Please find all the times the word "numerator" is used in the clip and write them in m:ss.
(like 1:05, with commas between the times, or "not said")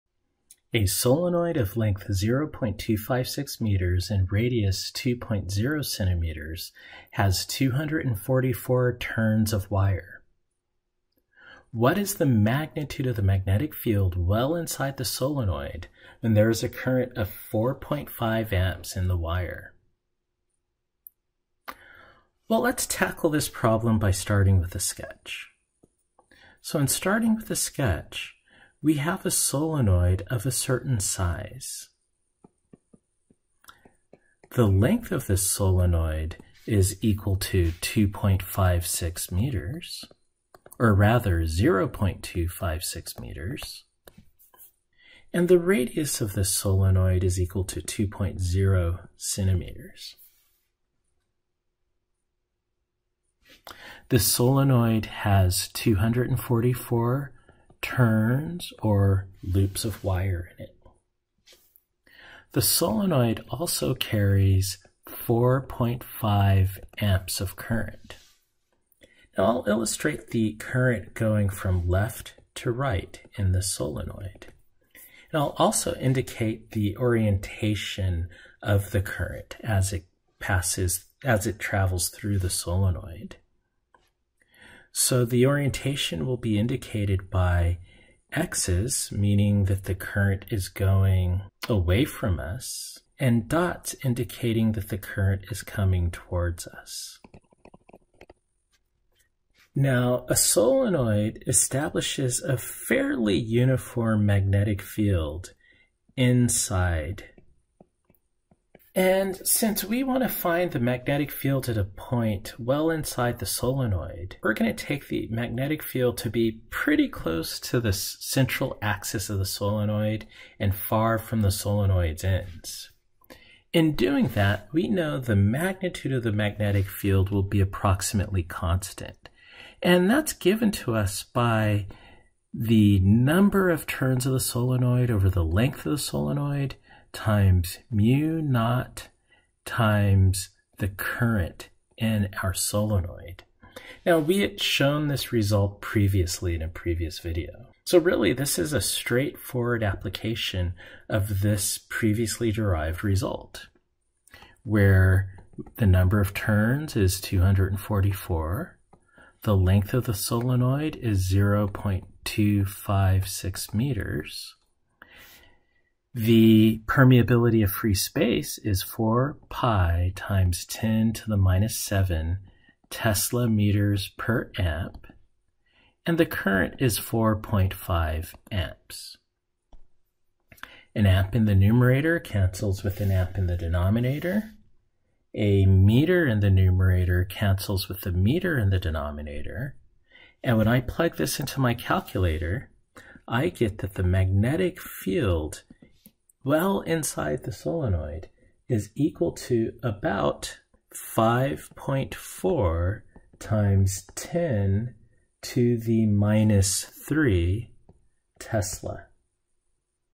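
3:01, 3:06.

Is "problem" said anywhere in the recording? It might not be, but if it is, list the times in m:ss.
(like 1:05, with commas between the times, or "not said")
0:23.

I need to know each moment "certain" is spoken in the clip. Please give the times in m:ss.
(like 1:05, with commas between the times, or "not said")
0:30.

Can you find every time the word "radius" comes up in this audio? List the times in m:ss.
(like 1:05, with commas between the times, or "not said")
0:04, 0:45.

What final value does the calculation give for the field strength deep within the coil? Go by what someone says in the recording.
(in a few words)
5.4 times 10^-3 Tesla.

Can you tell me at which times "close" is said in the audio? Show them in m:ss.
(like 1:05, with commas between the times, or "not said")
1:57.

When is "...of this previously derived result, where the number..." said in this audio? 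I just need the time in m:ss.
2:31.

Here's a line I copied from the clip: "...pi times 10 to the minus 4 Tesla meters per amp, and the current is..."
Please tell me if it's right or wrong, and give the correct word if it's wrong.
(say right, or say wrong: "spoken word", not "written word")
wrong: "7", not "4".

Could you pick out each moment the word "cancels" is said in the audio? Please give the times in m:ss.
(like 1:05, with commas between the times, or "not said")
3:02, 3:07.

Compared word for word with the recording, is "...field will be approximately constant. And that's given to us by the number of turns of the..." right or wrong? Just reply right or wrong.
right.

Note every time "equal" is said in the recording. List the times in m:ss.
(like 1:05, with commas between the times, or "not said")
0:37, 0:47, 3:18.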